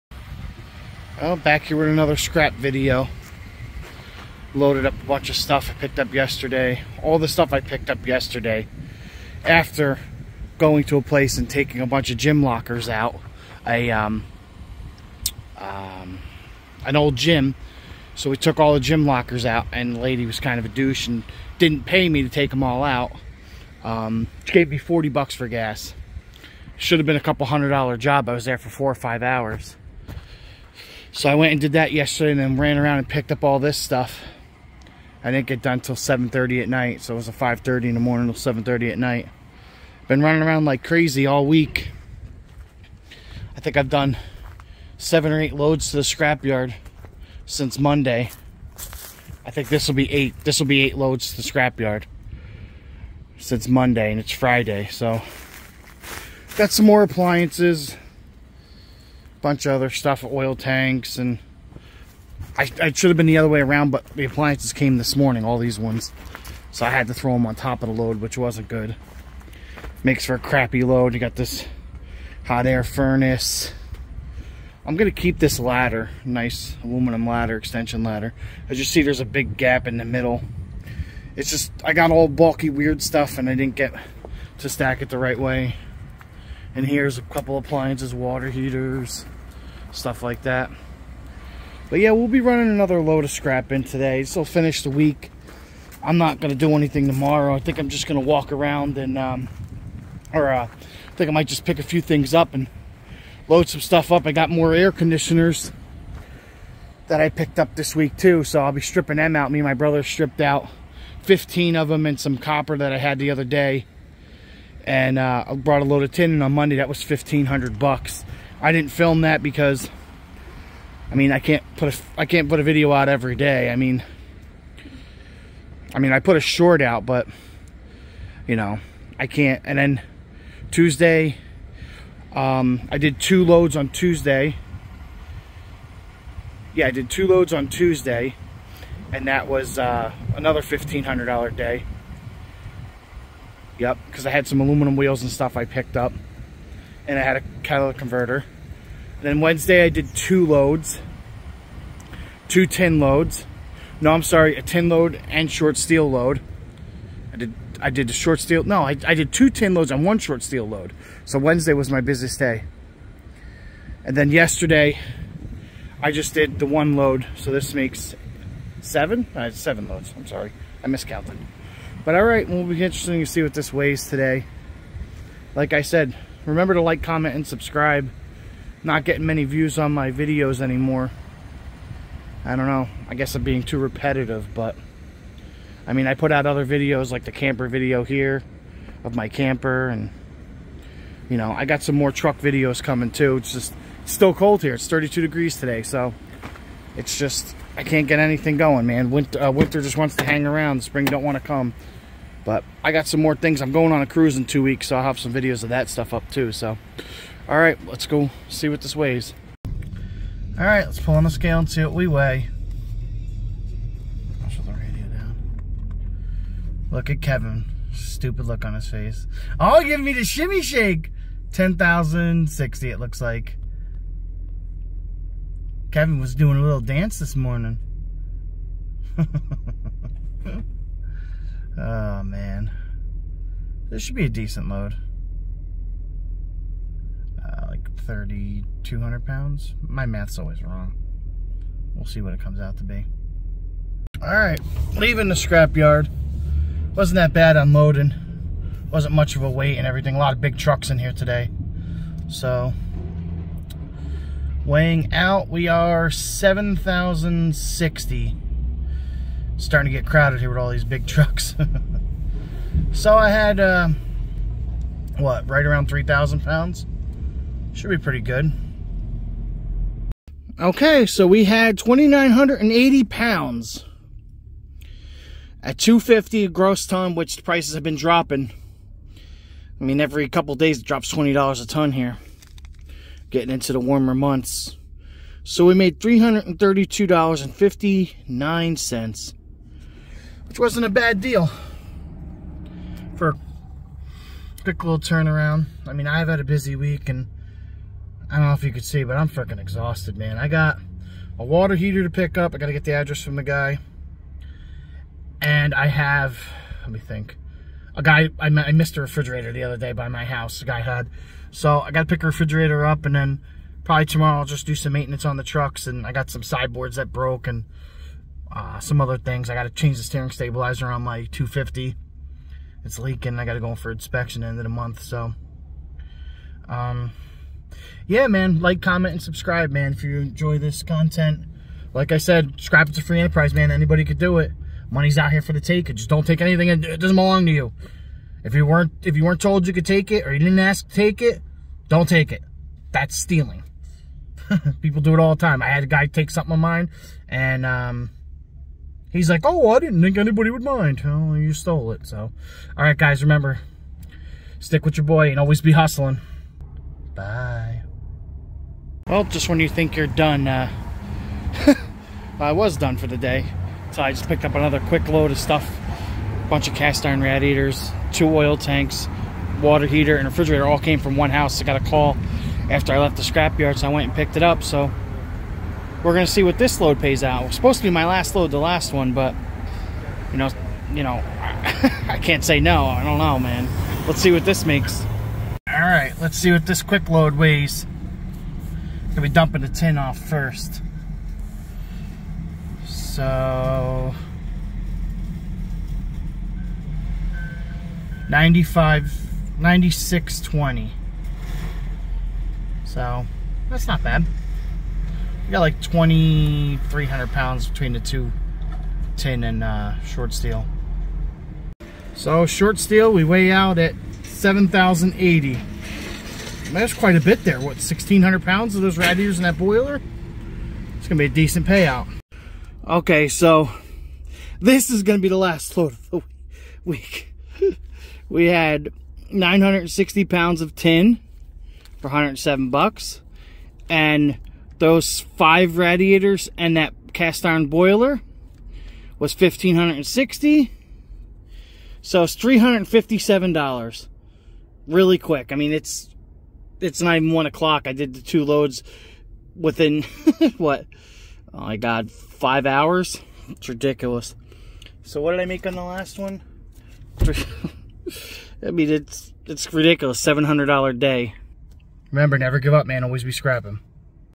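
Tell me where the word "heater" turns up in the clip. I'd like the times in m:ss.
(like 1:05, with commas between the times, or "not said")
1:28, 5:01, 6:09.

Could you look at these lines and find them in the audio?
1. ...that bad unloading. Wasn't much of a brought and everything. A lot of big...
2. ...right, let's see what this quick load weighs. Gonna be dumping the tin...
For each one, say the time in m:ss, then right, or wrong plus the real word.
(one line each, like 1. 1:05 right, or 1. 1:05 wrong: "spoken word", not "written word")
1. 4:07 wrong: "weight", not "brought"
2. 6:25 right.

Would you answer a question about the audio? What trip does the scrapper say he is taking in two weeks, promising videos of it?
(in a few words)
A cruise.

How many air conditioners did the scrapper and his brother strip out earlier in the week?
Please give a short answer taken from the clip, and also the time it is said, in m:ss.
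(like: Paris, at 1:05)
15, at 1:51.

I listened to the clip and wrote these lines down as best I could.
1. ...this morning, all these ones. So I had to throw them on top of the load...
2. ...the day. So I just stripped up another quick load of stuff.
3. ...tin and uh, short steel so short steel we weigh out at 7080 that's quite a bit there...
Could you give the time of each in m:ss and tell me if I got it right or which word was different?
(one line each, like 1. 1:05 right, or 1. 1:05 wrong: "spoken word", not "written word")
1. 1:04 right
2. 6:03 wrong: "picked", not "stripped"
3. 6:49 right.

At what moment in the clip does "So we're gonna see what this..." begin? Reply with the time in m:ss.
6:14.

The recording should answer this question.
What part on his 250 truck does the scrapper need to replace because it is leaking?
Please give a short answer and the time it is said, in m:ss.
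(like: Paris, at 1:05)
Steering stabilizer, at 5:20.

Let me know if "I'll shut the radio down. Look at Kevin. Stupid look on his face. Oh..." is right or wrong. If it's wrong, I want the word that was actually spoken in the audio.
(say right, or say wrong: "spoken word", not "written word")
right.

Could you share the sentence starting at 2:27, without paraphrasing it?
And I had a catalytic converter.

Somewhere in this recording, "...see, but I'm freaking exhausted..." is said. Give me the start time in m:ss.
4:58.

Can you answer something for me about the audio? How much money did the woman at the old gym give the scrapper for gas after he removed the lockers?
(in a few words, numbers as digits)
40 bucks.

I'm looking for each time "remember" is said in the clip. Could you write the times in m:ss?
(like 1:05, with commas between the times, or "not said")
2:56, 5:53, 7:42.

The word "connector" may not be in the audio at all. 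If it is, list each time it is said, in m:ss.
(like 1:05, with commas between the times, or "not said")
not said.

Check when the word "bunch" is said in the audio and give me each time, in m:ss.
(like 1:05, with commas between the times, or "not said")
0:05, 0:11, 0:59, 6:06.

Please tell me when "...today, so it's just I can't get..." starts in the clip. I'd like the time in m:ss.
3:15.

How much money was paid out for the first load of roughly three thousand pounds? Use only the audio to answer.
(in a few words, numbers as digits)
$332.59.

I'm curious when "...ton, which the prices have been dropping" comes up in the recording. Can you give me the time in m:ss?
4:36.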